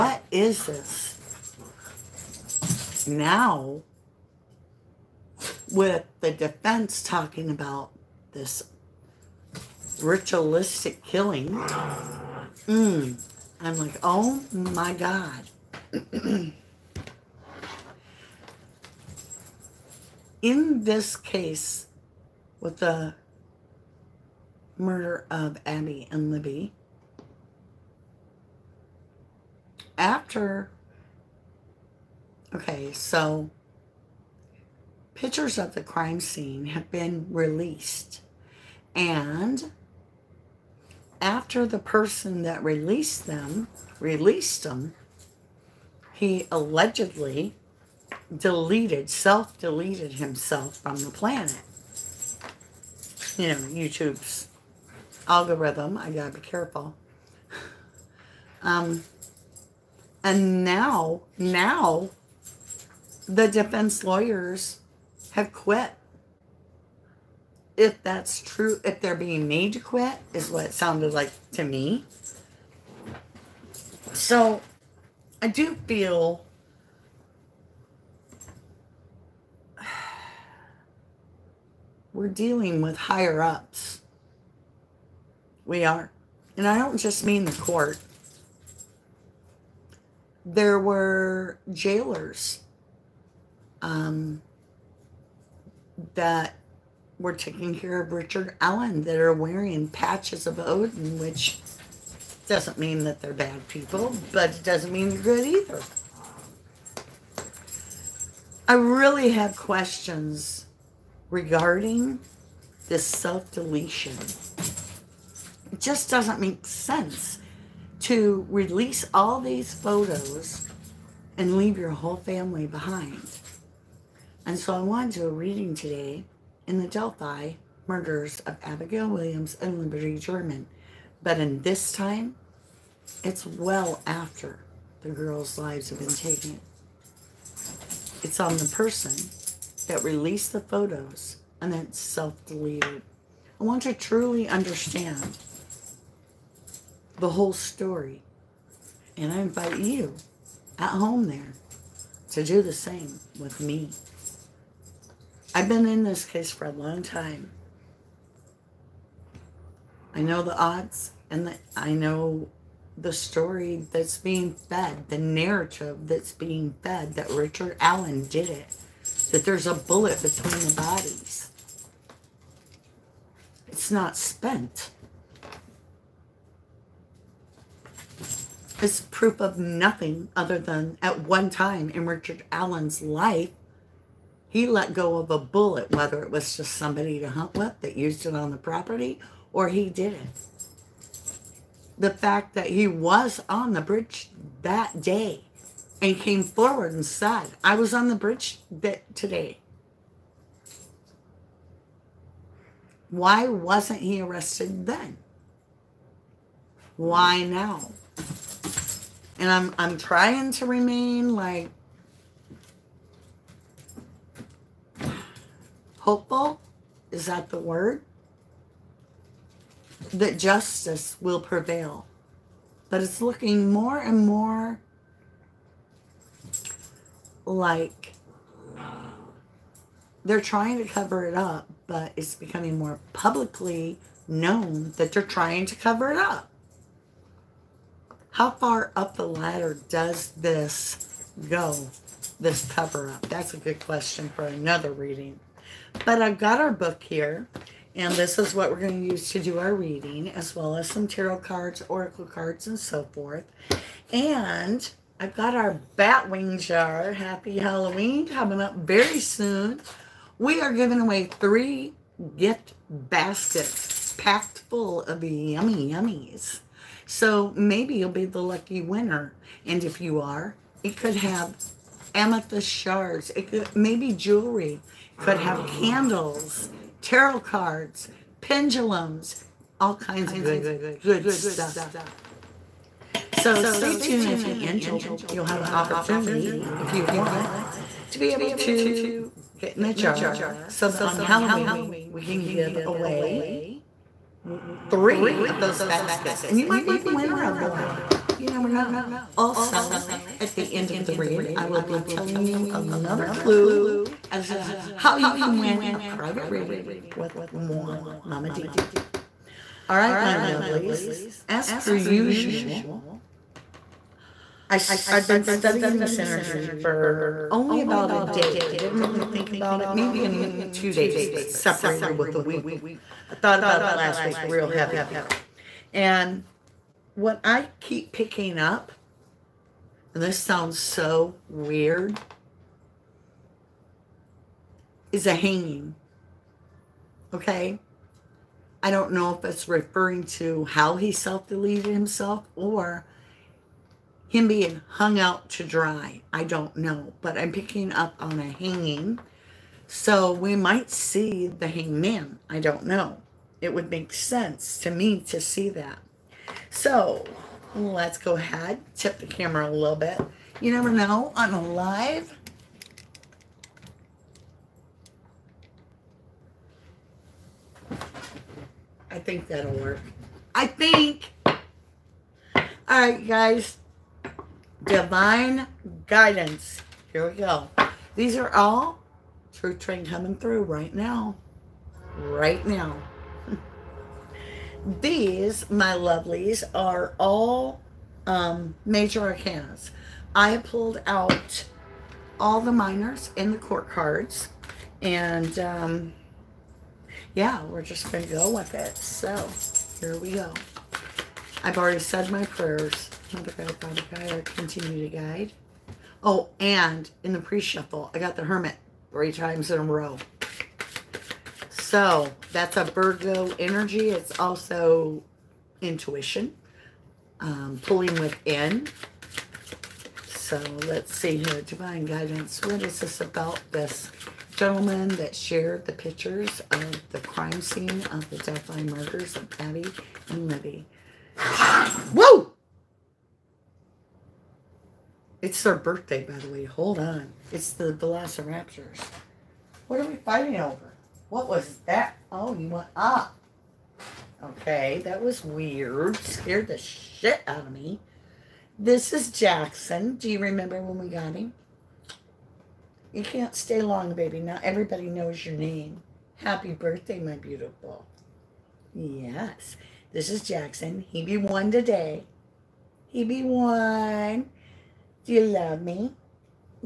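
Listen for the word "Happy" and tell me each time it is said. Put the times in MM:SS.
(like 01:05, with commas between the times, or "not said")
04:17, 07:36.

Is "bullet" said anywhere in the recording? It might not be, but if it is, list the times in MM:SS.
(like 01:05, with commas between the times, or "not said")
02:49, 03:05.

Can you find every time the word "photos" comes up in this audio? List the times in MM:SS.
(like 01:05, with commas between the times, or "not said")
01:59, 02:20.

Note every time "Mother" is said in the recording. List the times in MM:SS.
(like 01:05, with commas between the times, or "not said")
06:43.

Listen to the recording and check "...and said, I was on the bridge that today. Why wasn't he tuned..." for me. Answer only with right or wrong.
wrong.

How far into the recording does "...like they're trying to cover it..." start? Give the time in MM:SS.
03:47.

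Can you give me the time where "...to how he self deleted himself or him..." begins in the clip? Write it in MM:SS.
05:40.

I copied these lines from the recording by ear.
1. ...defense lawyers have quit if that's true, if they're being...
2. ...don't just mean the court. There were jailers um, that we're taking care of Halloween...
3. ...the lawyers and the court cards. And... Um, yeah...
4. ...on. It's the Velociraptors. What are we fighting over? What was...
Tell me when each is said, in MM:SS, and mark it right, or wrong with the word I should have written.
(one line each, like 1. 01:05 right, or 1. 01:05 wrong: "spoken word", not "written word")
1. 01:03 right
2. 01:26 wrong: "Richard", not "Halloween"
3. 06:32 wrong: "minors", not "lawyers"
4. 07:16 right.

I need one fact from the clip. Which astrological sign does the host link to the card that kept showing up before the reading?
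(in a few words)
Virgo.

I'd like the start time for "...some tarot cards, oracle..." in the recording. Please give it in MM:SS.
04:10.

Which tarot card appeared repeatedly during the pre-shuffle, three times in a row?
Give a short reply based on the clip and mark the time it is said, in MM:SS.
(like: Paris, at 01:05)
The Hermit, at 06:48.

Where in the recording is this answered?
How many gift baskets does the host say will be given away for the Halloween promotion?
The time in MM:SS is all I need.
04:21.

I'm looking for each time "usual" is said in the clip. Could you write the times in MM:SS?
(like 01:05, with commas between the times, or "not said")
05:11.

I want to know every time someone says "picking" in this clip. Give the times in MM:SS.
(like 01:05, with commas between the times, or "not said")
05:28, 05:47.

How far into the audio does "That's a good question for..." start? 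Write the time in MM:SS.
04:03.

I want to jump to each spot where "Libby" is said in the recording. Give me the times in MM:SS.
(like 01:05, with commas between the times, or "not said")
00:26, 07:10.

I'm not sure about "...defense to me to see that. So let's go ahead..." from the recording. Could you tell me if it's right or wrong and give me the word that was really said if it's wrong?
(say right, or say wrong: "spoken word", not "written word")
wrong: "sense", not "defense".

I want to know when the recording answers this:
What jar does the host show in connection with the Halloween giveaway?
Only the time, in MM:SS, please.
04:15.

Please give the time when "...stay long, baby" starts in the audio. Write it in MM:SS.
07:33.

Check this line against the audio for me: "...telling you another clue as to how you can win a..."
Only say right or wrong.
right.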